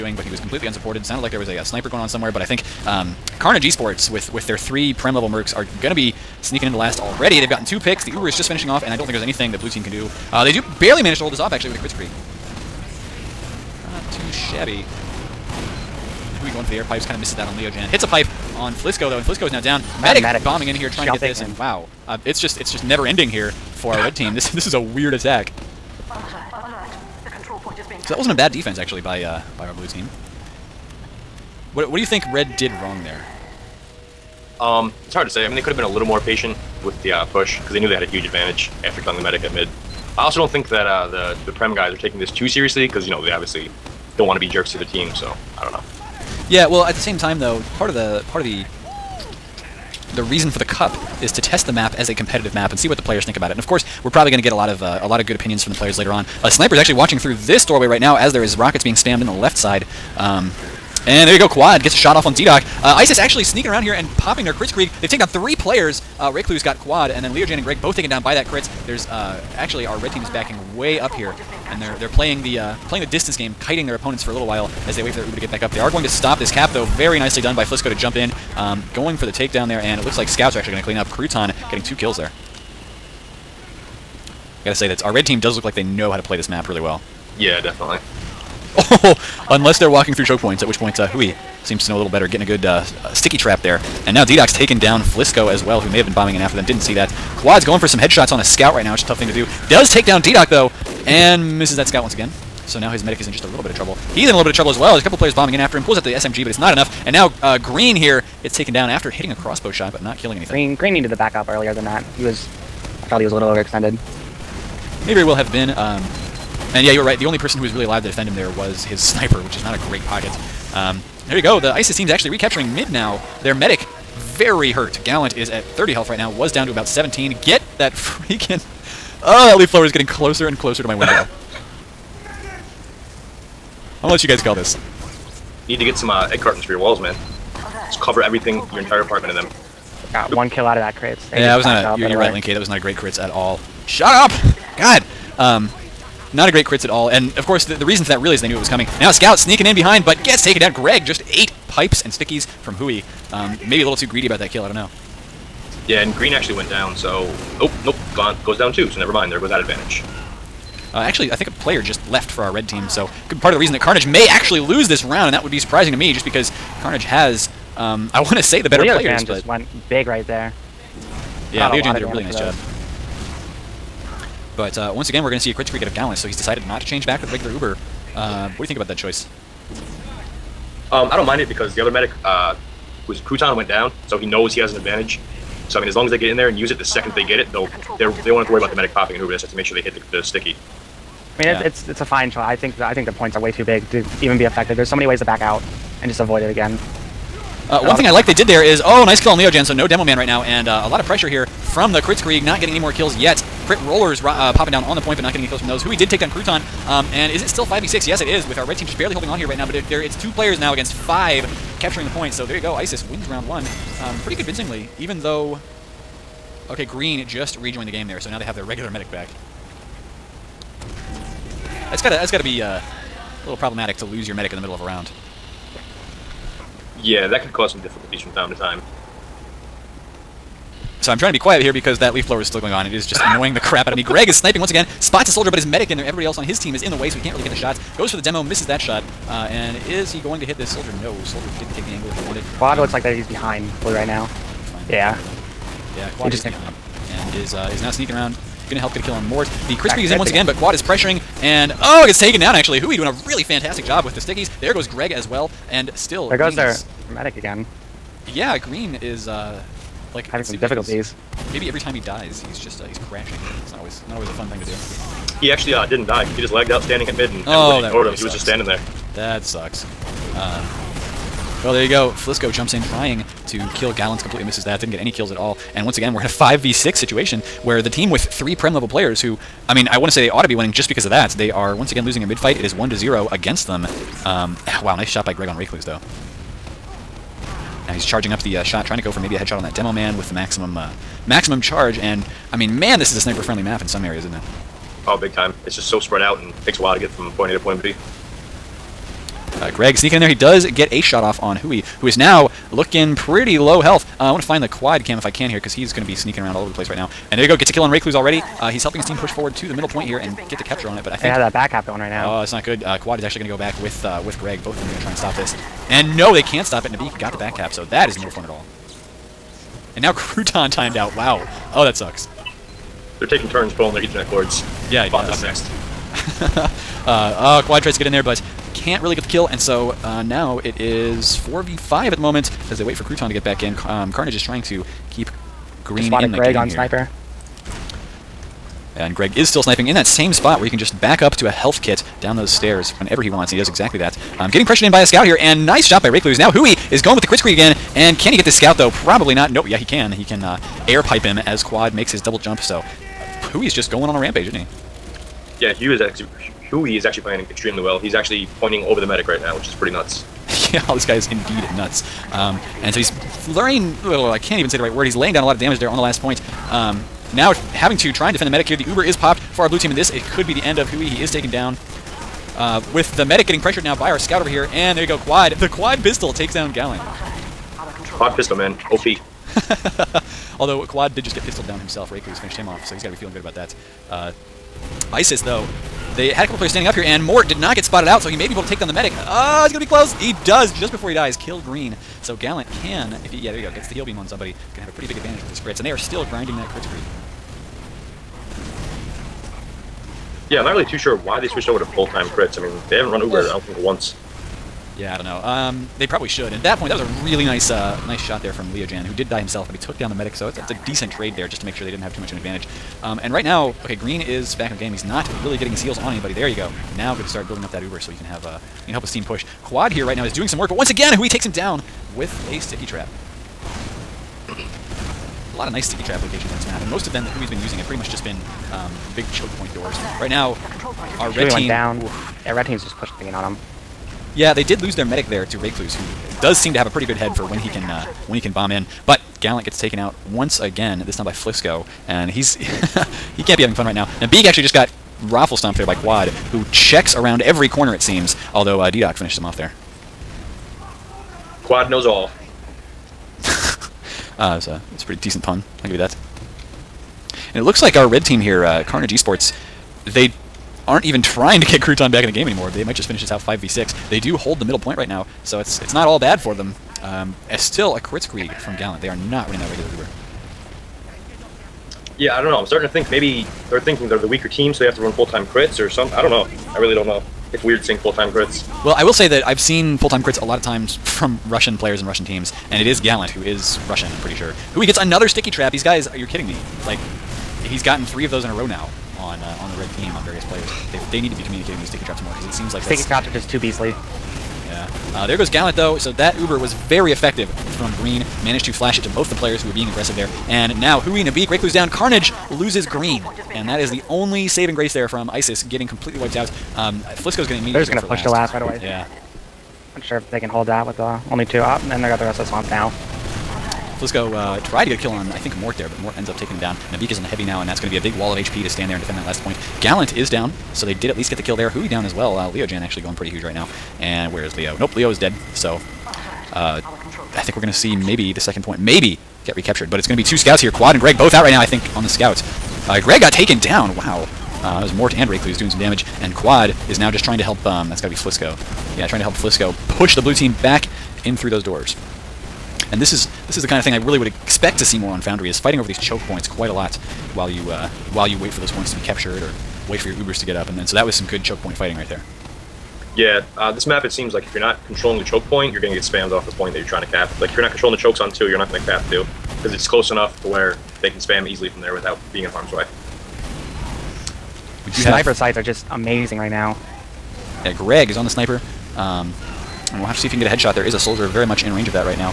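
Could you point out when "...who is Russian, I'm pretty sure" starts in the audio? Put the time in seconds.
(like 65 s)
483 s.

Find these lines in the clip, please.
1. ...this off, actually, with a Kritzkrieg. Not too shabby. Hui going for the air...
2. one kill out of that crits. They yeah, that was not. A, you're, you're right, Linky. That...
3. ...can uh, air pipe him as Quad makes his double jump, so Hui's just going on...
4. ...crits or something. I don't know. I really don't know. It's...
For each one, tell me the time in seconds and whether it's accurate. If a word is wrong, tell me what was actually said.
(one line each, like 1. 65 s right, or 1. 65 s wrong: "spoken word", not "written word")
1. 11 s right
2. 140 s right
3. 350 s right
4. 475 s right.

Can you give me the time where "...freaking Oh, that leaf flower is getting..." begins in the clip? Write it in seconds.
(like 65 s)
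127 s.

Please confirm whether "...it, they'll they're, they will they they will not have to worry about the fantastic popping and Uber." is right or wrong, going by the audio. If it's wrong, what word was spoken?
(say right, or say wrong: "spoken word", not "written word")
wrong: "medic", not "fantastic".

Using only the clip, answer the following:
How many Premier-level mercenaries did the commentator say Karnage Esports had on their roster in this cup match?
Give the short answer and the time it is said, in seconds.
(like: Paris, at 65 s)
3, at 4 s.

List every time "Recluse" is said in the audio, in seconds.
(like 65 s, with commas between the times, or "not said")
285 s, 307 s, 346 s, 435 s, 535 s.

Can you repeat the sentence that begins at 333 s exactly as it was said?
Um, Karnage is trying to keep Green Just in the Greg on here.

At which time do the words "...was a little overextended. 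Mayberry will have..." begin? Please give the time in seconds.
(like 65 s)
113 s.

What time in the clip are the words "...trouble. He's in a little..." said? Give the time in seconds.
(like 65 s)
103 s.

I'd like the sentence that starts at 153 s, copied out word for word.
Um, maybe a little too greedy about that kill, I don't know.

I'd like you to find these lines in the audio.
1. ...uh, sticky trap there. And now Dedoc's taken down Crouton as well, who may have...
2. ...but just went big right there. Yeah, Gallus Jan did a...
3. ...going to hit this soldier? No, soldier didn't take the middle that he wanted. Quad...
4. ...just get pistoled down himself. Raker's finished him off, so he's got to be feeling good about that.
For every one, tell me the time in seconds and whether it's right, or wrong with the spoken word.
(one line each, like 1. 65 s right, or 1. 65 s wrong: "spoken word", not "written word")
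1. 92 s wrong: "Flisco", not "Crouton"
2. 169 s wrong: "Leo", not "Gallus"
3. 240 s wrong: "angle", not "middle"
4. 381 s right.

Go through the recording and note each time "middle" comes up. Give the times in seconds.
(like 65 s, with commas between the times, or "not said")
224 s, 309 s, 464 s.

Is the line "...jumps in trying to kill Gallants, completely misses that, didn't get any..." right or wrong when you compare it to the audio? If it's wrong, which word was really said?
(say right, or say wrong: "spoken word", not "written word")
right.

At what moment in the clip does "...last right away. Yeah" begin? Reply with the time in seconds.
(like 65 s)
508 s.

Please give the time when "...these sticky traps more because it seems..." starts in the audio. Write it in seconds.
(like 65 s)
491 s.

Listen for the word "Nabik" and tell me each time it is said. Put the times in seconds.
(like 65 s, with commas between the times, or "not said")
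316 s, 501 s, 516 s.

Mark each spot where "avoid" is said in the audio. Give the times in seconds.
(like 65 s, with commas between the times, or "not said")
196 s.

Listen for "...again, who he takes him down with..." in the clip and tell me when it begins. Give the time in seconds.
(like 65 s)
420 s.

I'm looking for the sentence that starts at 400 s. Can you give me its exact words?
Yeah, I'm not really too sure why they switched over to full-time crits.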